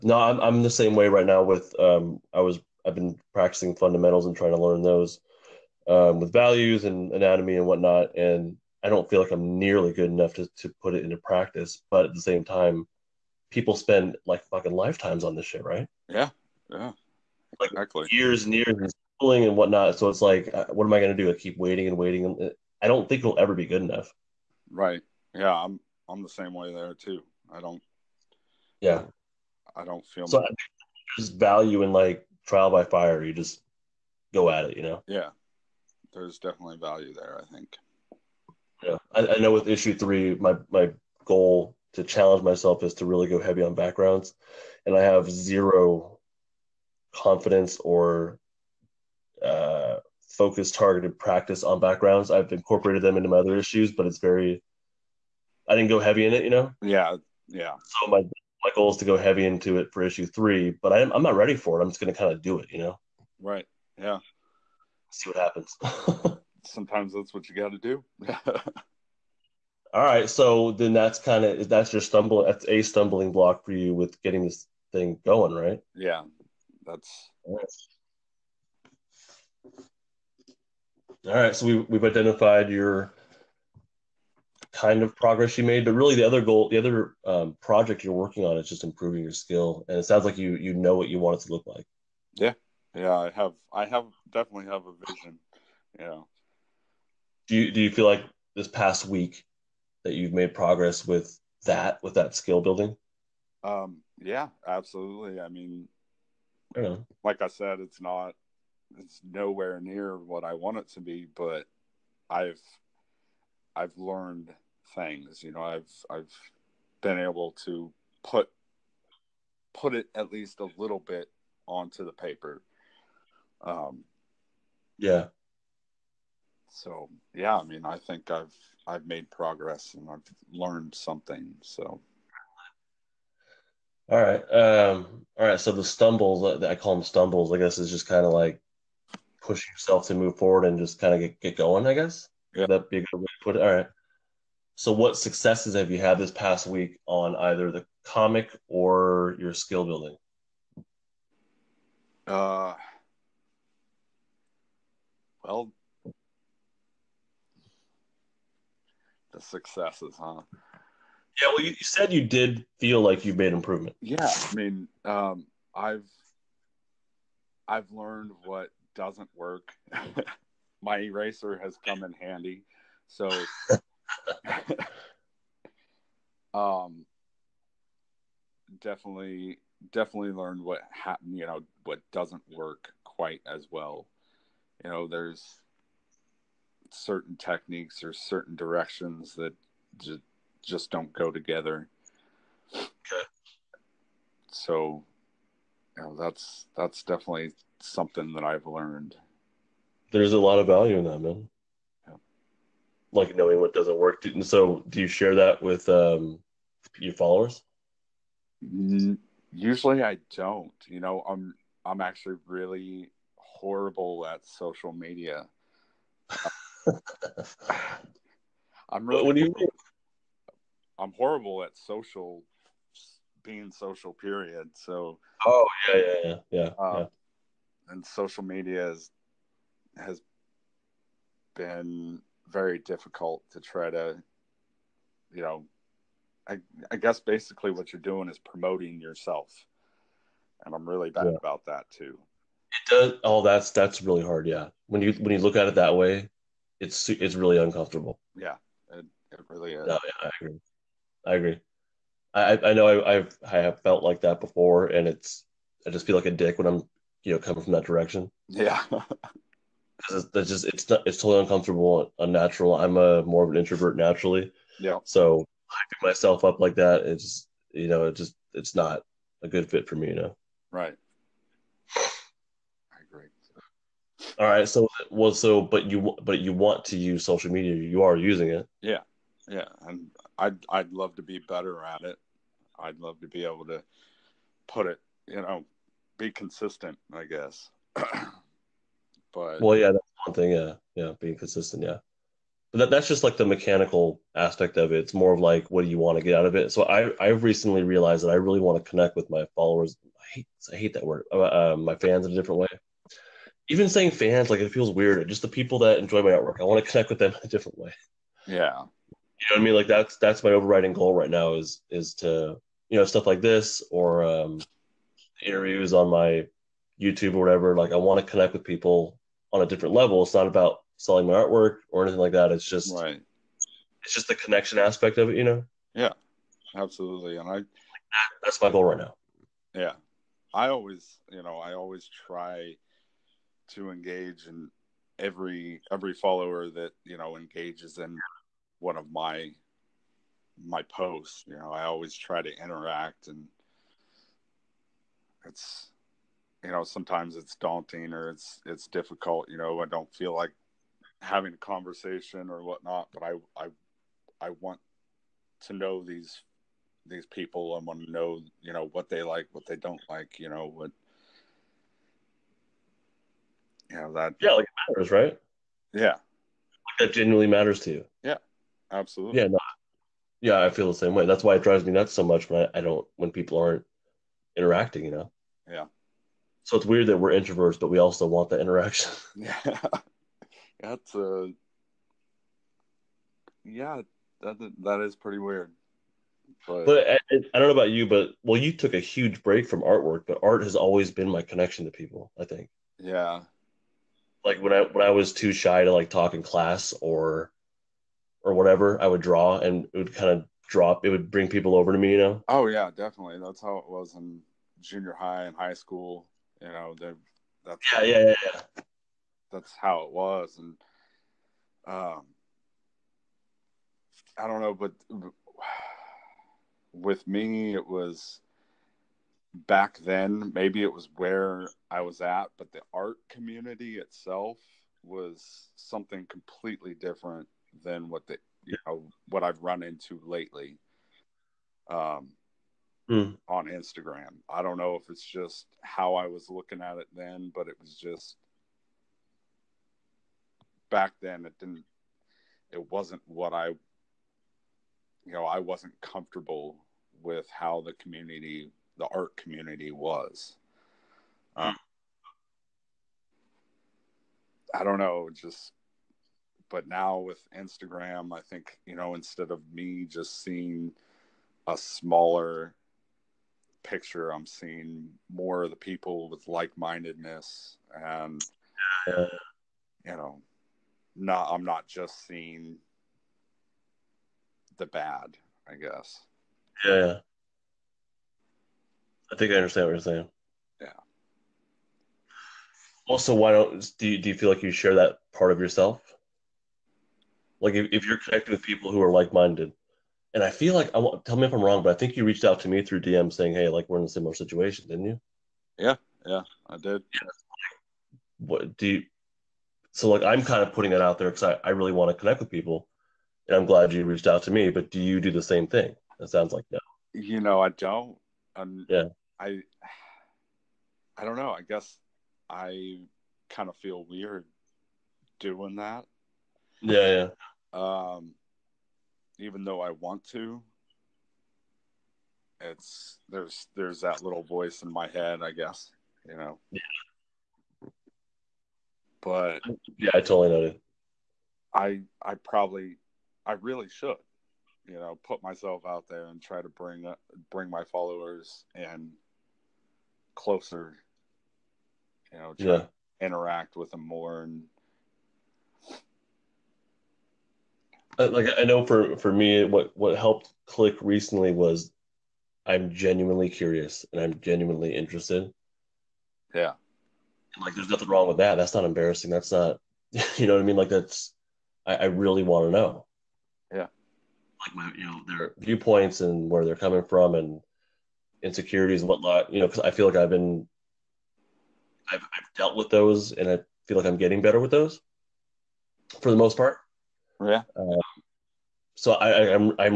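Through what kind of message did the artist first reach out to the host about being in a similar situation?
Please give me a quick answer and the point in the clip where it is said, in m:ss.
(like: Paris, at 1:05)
DM, at 8:13.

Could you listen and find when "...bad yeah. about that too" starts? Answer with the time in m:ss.
4:01.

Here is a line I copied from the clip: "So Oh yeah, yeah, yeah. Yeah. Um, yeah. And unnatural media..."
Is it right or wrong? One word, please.
wrong.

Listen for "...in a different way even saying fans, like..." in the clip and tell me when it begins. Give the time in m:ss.
5:02.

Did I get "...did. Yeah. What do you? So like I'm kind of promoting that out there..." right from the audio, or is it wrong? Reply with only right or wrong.
wrong.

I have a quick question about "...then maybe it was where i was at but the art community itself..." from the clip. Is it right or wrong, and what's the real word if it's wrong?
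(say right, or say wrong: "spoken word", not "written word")
right.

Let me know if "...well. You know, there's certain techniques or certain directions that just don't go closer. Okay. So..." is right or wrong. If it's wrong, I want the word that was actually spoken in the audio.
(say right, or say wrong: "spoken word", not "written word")
wrong: "together", not "closer".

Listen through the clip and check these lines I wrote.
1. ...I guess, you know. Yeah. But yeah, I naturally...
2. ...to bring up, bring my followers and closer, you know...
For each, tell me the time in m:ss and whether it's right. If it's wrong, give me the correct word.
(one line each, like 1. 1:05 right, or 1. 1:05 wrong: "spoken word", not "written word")
1. 8:45 wrong: "totally", not "naturally"
2. 8:56 right.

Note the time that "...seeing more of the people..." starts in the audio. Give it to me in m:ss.
7:44.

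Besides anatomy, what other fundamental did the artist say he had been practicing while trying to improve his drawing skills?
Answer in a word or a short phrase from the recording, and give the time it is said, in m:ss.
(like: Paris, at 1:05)
values, at 0:06.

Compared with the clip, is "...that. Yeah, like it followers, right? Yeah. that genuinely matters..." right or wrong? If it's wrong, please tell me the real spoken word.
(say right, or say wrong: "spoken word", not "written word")
wrong: "matters", not "followers".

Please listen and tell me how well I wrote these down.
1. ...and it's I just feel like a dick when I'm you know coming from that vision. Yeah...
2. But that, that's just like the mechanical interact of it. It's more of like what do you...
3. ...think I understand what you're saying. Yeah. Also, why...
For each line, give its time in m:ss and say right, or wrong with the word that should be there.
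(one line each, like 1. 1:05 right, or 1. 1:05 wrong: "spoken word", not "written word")
1. 4:14 wrong: "direction", not "vision"
2. 4:52 wrong: "aspect", not "interact"
3. 7:59 right.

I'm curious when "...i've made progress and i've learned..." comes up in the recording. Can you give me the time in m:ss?
2:08.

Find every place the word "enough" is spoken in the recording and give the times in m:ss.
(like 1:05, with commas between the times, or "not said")
0:10, 0:23.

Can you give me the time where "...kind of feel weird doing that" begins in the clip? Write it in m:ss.
8:33.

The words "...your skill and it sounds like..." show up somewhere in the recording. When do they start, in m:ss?
1:29.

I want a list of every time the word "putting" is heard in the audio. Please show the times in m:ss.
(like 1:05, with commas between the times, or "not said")
8:20.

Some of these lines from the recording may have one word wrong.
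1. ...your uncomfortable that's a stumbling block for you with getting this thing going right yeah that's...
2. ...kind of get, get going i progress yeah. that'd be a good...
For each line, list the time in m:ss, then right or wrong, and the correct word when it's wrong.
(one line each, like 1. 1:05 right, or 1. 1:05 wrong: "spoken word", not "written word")
1. 1:11 wrong: "stumble", not "uncomfortable"
2. 2:20 wrong: "guess", not "progress".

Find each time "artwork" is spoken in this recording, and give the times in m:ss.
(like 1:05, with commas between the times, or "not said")
5:06, 5:21, 6:29.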